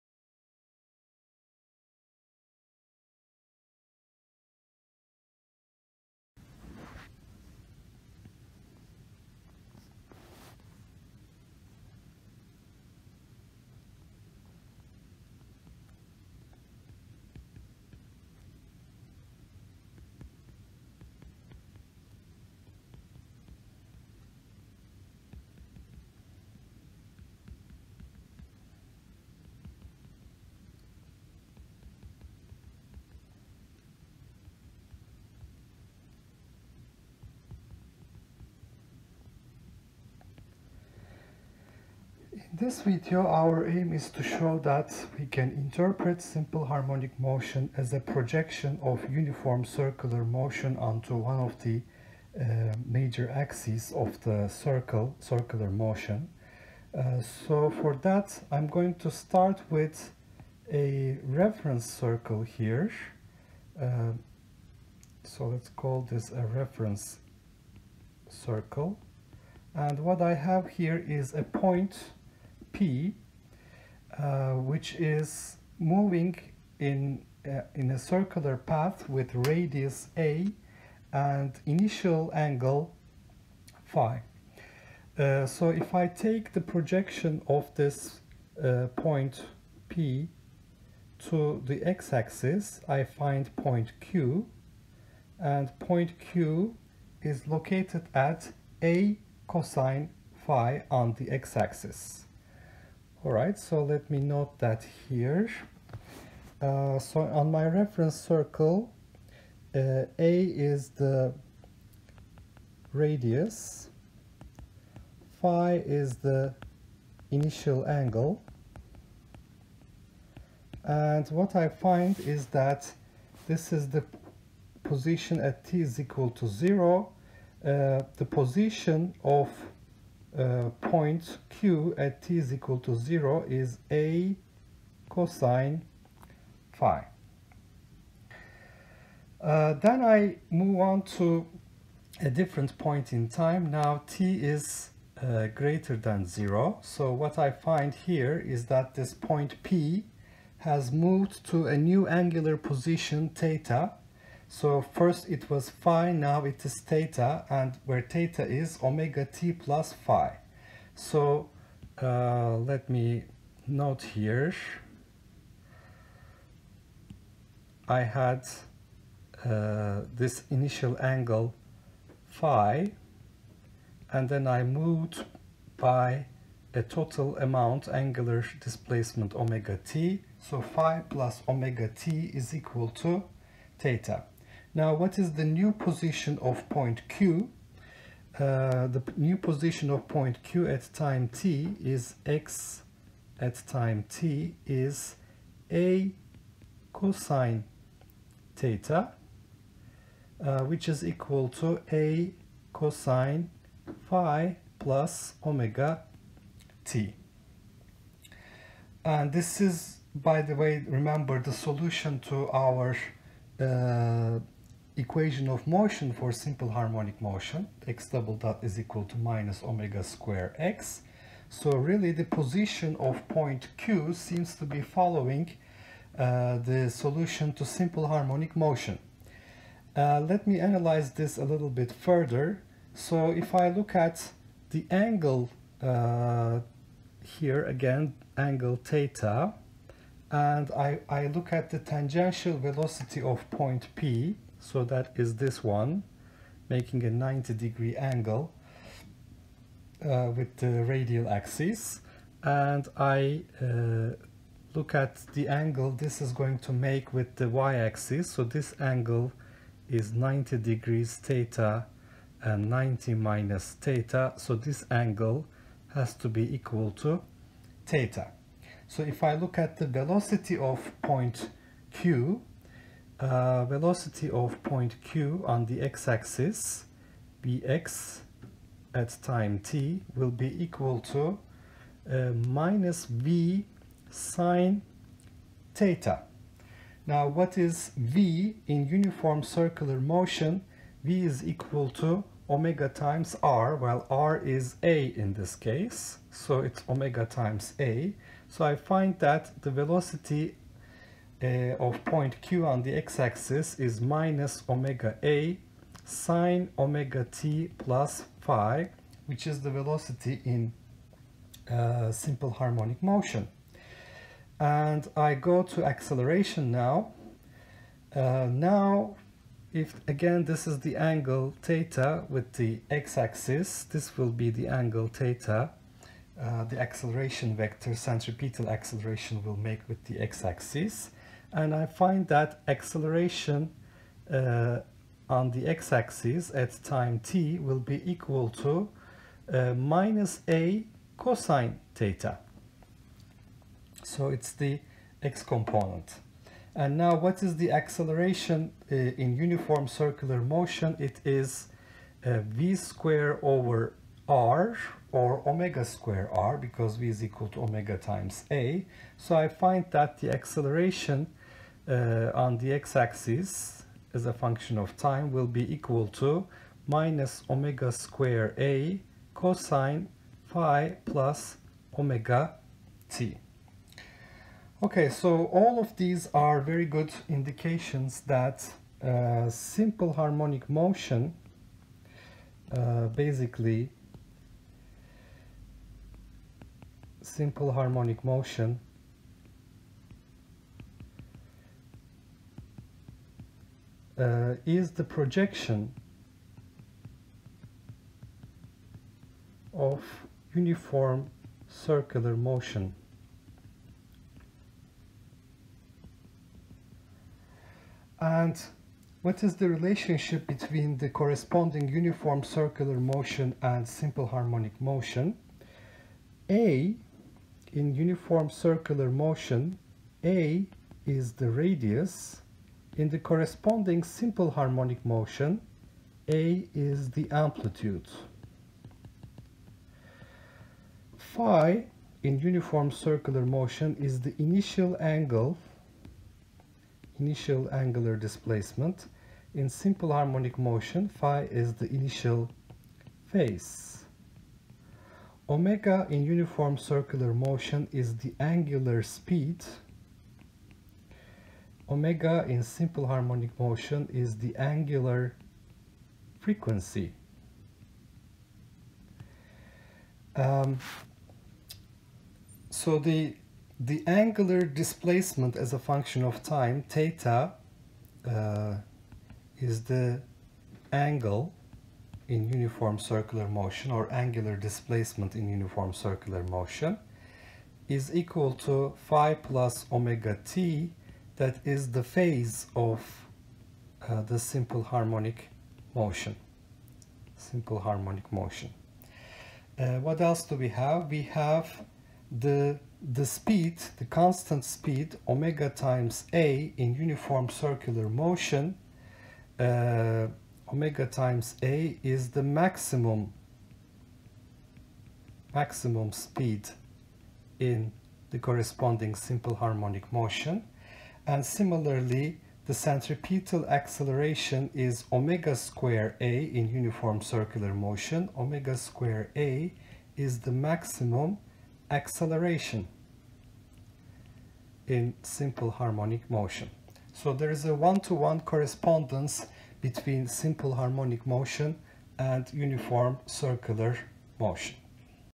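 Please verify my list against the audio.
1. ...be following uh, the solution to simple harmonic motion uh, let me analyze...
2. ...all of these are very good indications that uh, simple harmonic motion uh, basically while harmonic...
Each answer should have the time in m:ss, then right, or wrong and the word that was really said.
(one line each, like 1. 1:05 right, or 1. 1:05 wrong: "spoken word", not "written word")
1. 3:44 right
2. 6:15 wrong: "simple", not "while".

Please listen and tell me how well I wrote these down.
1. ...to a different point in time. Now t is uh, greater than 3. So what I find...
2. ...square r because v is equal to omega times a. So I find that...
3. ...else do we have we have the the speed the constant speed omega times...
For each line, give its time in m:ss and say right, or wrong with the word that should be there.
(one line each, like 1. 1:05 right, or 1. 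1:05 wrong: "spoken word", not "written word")
1. 2:21 wrong: "0", not "3"
2. 5:55 right
3. 8:10 right.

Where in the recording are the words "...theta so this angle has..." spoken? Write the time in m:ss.
4:23.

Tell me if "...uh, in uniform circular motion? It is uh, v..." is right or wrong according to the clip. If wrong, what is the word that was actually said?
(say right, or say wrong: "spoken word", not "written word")
right.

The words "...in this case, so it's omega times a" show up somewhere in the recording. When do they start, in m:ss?
4:55.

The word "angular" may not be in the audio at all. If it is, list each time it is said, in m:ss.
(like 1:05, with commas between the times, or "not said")
2:32, 2:57, 7:17, 7:28, 7:34, 7:44, 7:54.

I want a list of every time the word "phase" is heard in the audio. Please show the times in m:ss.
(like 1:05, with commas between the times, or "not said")
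7:23, 8:02.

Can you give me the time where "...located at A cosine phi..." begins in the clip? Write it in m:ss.
1:37.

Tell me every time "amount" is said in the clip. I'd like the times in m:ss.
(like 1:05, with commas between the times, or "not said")
2:57.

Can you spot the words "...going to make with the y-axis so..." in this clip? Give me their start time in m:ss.
4:16.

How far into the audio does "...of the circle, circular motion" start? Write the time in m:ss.
0:53.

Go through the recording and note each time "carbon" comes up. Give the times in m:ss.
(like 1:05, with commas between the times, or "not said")
not said.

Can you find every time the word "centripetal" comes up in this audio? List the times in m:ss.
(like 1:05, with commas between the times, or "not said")
5:27, 8:32.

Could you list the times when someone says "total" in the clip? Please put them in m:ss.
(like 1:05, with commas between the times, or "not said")
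2:56.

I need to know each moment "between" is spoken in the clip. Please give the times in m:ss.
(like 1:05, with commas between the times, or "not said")
6:50, 8:49.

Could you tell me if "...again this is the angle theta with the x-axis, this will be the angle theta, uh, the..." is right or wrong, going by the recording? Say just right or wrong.
right.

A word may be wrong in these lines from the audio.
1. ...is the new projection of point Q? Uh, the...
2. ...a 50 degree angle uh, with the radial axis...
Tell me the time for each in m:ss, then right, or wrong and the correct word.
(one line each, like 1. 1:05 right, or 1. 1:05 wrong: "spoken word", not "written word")
1. 3:05 wrong: "position", not "projection"
2. 4:07 wrong: "90", not "50".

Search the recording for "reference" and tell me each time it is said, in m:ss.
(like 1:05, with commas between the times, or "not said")
1:01, 1:06, 1:47.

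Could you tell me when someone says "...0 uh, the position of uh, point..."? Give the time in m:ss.
2:06.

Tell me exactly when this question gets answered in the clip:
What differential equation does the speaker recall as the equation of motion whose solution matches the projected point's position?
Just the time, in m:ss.
3:37.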